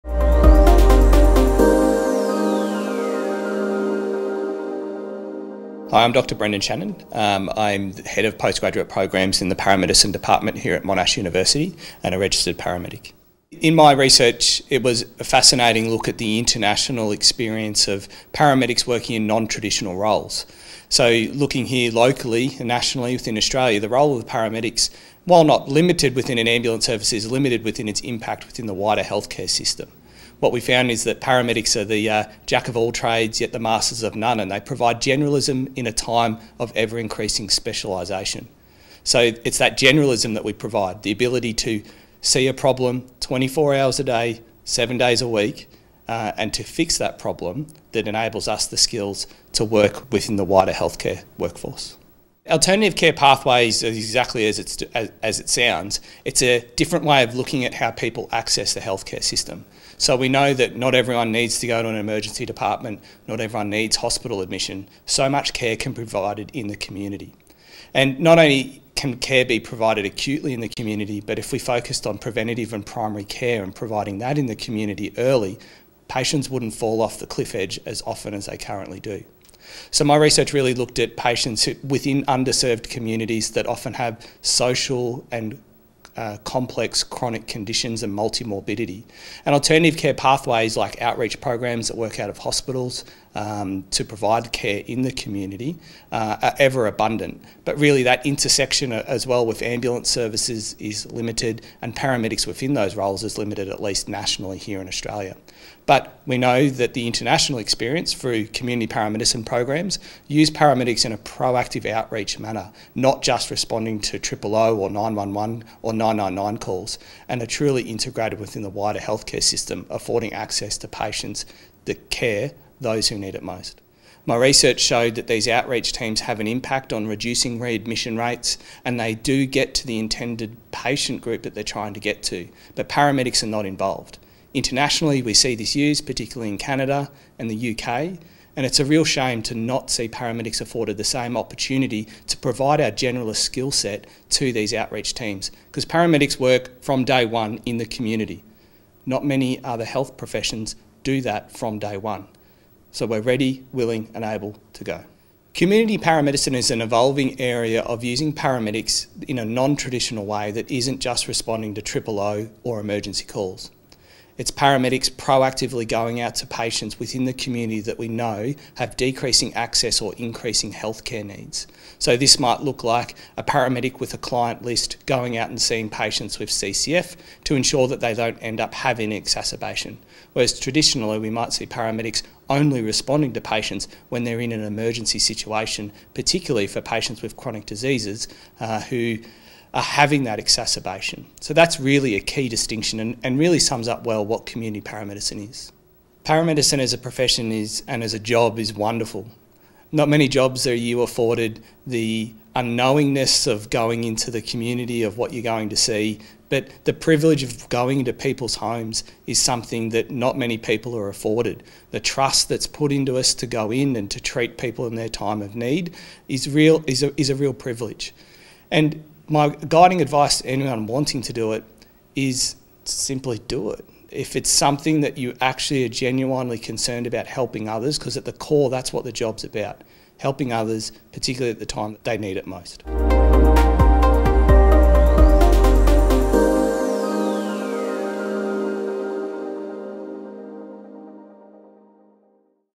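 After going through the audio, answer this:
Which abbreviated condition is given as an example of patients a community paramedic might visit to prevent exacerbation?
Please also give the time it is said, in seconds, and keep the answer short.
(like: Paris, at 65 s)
CCF, at 176 s.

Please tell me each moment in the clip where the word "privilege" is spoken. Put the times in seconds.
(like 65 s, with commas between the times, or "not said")
206 s, 217 s.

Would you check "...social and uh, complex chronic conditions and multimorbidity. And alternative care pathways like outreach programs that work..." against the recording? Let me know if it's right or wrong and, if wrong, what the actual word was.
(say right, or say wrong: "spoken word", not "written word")
right.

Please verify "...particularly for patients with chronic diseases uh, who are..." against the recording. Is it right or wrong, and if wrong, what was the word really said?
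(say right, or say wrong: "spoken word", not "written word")
right.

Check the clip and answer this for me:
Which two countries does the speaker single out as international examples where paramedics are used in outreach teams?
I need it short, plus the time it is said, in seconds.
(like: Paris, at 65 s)
Canada and the UK, at 136 s.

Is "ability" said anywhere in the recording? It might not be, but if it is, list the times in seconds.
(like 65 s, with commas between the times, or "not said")
41 s.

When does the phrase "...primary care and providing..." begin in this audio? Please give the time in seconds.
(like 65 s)
72 s.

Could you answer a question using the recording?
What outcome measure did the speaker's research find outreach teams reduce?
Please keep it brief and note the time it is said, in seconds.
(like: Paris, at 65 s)
Readmission rates, at 127 s.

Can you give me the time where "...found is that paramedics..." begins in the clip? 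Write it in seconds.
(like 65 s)
30 s.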